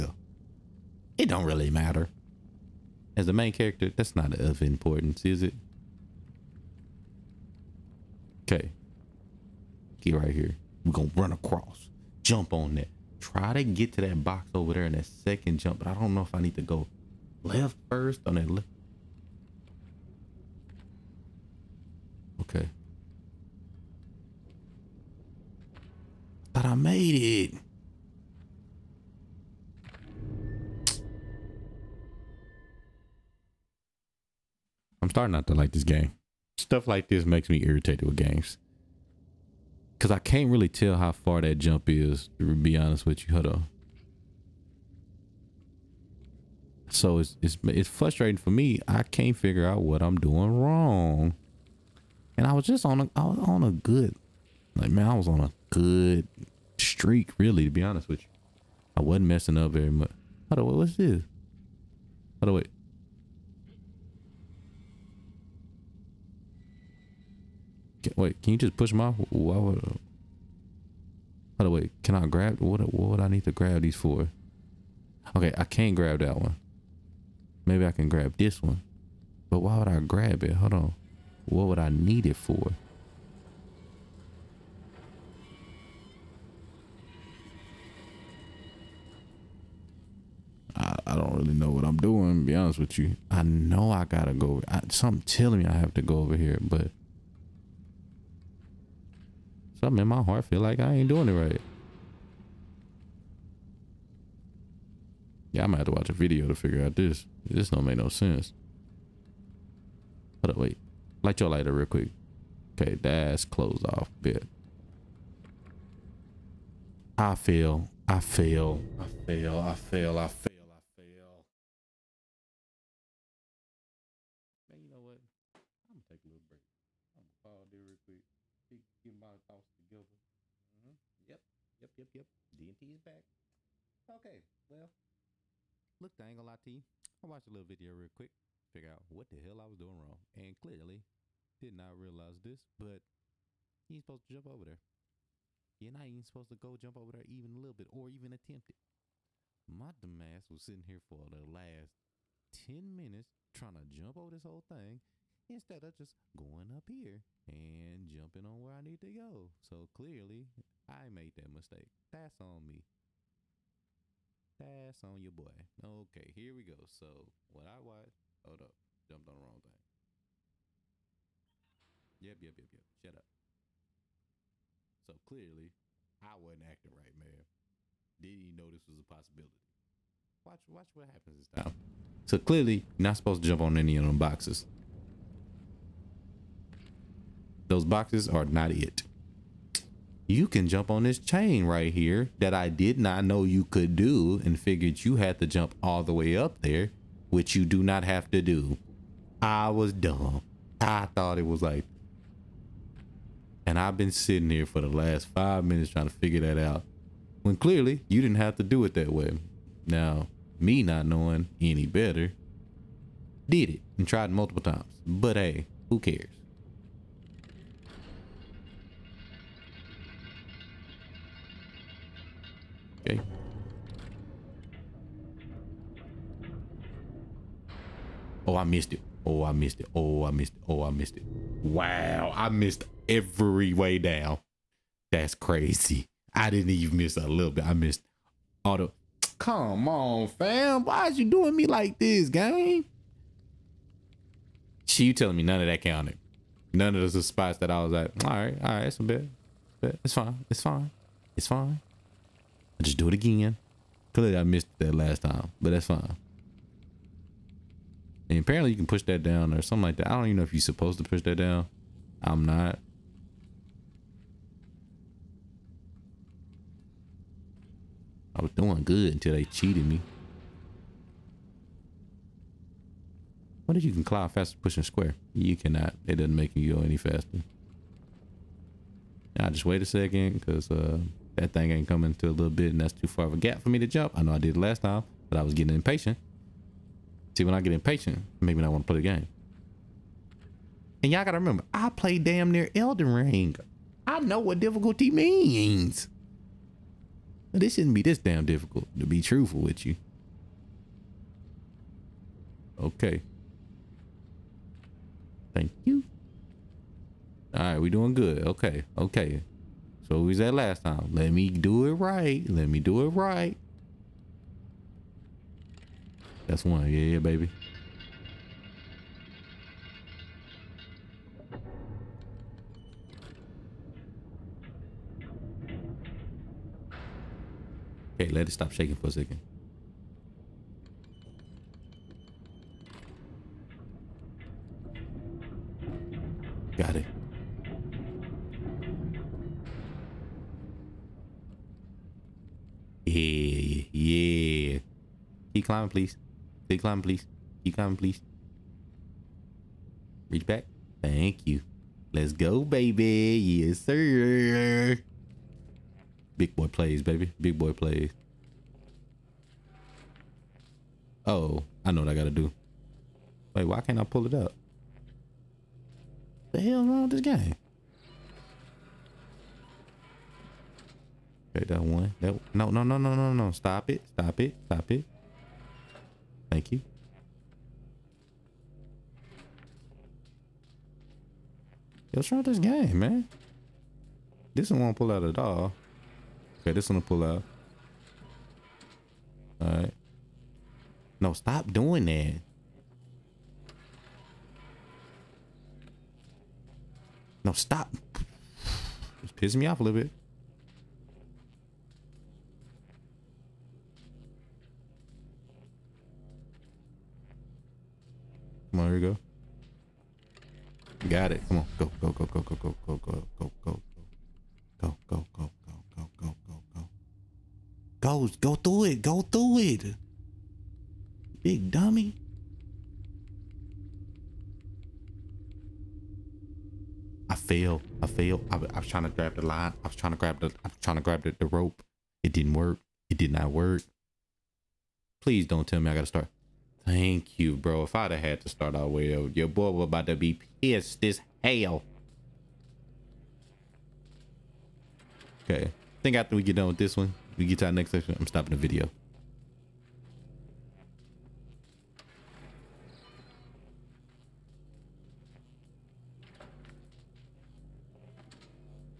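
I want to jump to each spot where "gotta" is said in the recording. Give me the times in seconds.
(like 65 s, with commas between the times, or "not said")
94 s, 291 s, 362 s, 435 s.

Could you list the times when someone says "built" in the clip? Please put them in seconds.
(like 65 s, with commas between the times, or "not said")
not said.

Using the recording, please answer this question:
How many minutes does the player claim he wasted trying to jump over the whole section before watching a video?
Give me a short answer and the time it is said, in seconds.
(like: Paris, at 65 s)
10, at 152 s.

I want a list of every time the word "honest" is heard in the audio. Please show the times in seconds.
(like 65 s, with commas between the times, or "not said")
42 s, 57 s, 92 s.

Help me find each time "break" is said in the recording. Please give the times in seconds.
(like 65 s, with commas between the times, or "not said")
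126 s.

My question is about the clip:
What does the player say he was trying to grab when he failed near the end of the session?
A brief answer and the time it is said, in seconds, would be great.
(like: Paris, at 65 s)
the rope, at 431 s.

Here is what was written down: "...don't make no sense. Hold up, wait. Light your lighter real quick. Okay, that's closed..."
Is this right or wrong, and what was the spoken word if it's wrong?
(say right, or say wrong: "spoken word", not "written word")
right.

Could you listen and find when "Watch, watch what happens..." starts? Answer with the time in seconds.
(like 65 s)
180 s.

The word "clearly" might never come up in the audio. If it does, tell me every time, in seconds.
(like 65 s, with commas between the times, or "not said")
140 s, 159 s, 175 s, 182 s, 207 s, 254 s.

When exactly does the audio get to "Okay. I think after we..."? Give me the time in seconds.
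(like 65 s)
445 s.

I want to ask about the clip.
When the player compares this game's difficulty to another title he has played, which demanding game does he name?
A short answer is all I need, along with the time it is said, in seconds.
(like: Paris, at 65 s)
Elden Ring, at 292 s.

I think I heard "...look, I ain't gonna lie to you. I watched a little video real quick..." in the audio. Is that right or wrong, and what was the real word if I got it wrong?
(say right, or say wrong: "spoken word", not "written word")
right.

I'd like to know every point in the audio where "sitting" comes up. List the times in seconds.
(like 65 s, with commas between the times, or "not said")
150 s, 204 s.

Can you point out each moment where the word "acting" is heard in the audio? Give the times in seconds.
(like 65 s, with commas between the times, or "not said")
176 s.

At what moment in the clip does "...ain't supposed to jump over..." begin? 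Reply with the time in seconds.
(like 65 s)
143 s.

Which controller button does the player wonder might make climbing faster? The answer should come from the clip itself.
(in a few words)
square.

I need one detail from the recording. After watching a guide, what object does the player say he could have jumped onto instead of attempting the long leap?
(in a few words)
chain.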